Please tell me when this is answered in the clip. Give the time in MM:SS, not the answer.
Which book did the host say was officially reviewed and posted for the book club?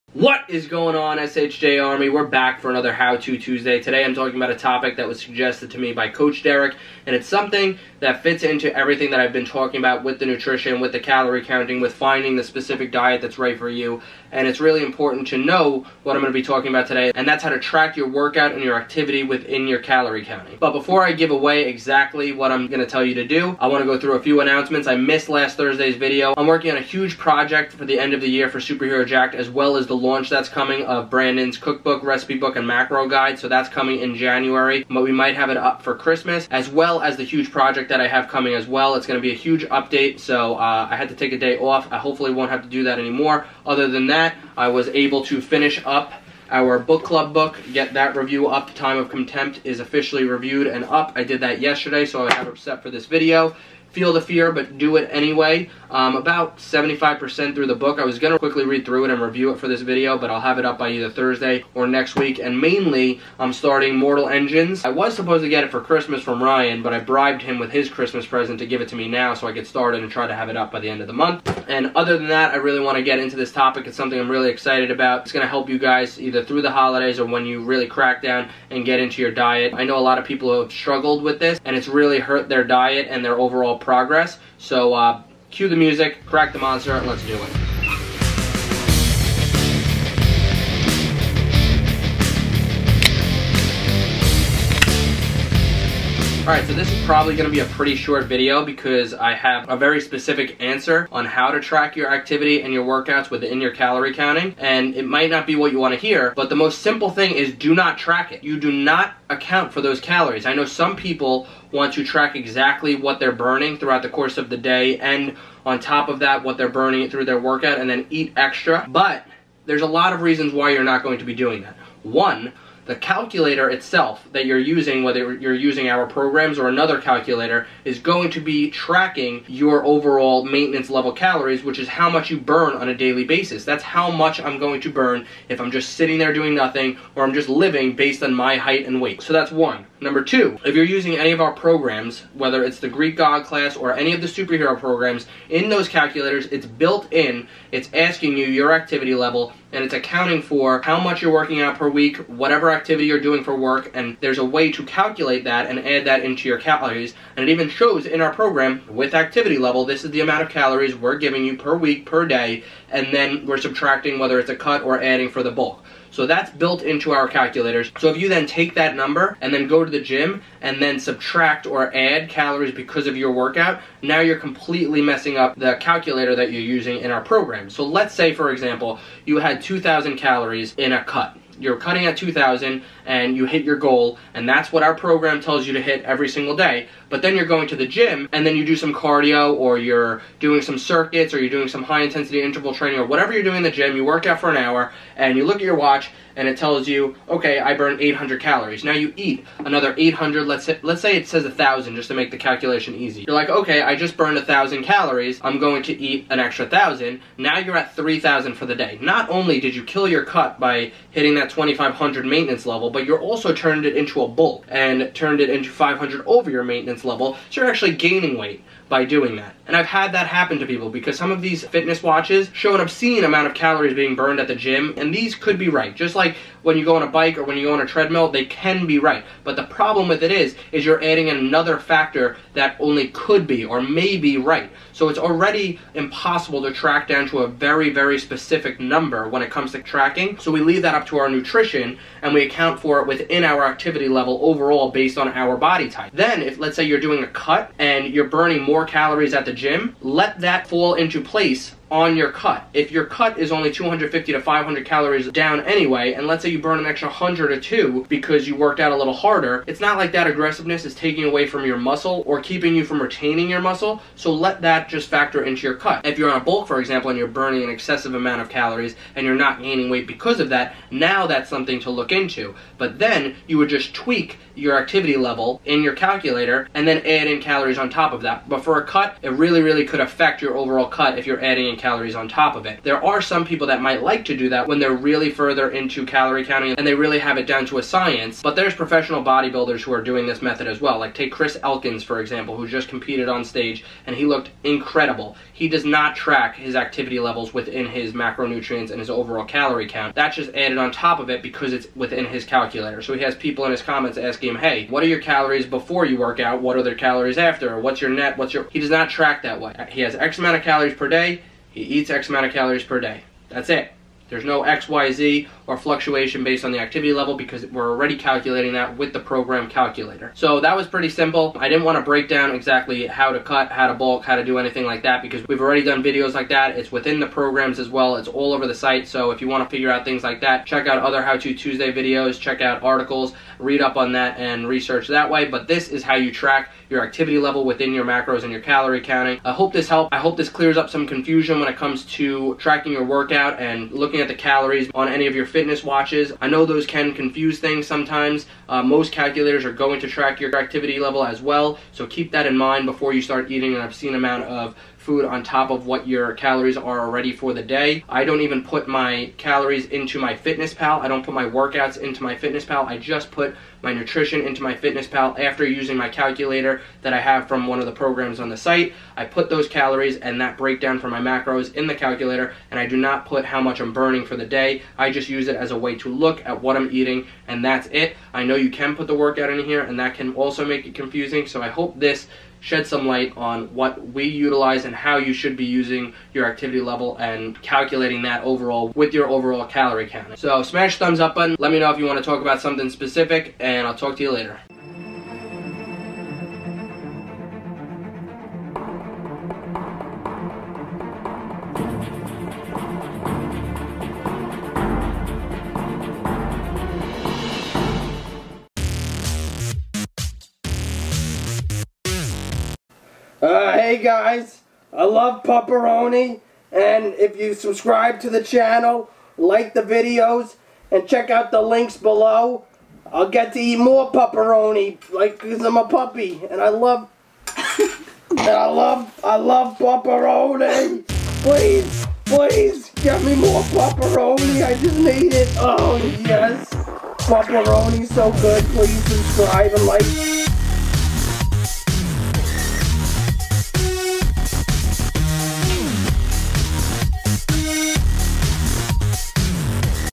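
00:48.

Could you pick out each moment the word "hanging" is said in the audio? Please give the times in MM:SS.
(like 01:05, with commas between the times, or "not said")
not said.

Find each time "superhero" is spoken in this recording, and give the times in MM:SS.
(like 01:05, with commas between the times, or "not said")
00:28, 02:24.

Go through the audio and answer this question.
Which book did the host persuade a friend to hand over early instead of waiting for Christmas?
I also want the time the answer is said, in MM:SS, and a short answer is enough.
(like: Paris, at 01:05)
Mortal Engines, at 01:03.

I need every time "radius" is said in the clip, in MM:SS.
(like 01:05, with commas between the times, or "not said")
not said.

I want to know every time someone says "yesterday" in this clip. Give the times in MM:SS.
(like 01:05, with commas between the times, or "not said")
00:51.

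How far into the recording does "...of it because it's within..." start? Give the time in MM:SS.
05:01.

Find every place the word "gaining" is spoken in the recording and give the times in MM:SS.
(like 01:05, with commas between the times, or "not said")
03:37, 04:29.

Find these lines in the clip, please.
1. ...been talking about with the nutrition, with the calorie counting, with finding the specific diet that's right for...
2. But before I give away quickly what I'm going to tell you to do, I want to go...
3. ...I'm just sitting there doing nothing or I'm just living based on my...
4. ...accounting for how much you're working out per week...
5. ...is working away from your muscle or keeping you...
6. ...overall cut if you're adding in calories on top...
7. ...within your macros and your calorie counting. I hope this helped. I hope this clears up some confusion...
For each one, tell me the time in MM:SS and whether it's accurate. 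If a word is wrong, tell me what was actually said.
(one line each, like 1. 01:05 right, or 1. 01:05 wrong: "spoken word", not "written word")
1. 00:09 right
2. 00:20 wrong: "exactly", not "quickly"
3. 02:15 right
4. 02:29 right
5. 04:20 wrong: "taking", not "working"
6. 04:40 right
7. 05:37 right.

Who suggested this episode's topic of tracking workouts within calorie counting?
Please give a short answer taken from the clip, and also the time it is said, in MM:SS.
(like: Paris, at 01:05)
Coach Derek, at 00:06.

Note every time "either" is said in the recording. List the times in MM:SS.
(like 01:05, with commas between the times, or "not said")
01:00, 01:16.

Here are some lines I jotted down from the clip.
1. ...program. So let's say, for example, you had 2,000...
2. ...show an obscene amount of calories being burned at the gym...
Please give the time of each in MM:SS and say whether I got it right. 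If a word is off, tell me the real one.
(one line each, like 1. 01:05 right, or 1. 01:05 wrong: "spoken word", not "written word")
1. 02:57 right
2. 03:42 right.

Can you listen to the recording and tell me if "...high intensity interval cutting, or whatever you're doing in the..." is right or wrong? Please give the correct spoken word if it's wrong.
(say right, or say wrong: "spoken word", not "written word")
wrong: "training", not "cutting".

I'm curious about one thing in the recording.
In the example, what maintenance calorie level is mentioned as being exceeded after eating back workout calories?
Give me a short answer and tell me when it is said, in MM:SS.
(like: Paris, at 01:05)
2,500, at 03:31.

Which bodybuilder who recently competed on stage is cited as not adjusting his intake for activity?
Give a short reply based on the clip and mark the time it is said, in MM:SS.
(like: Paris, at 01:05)
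Chris Elkins, at 04:51.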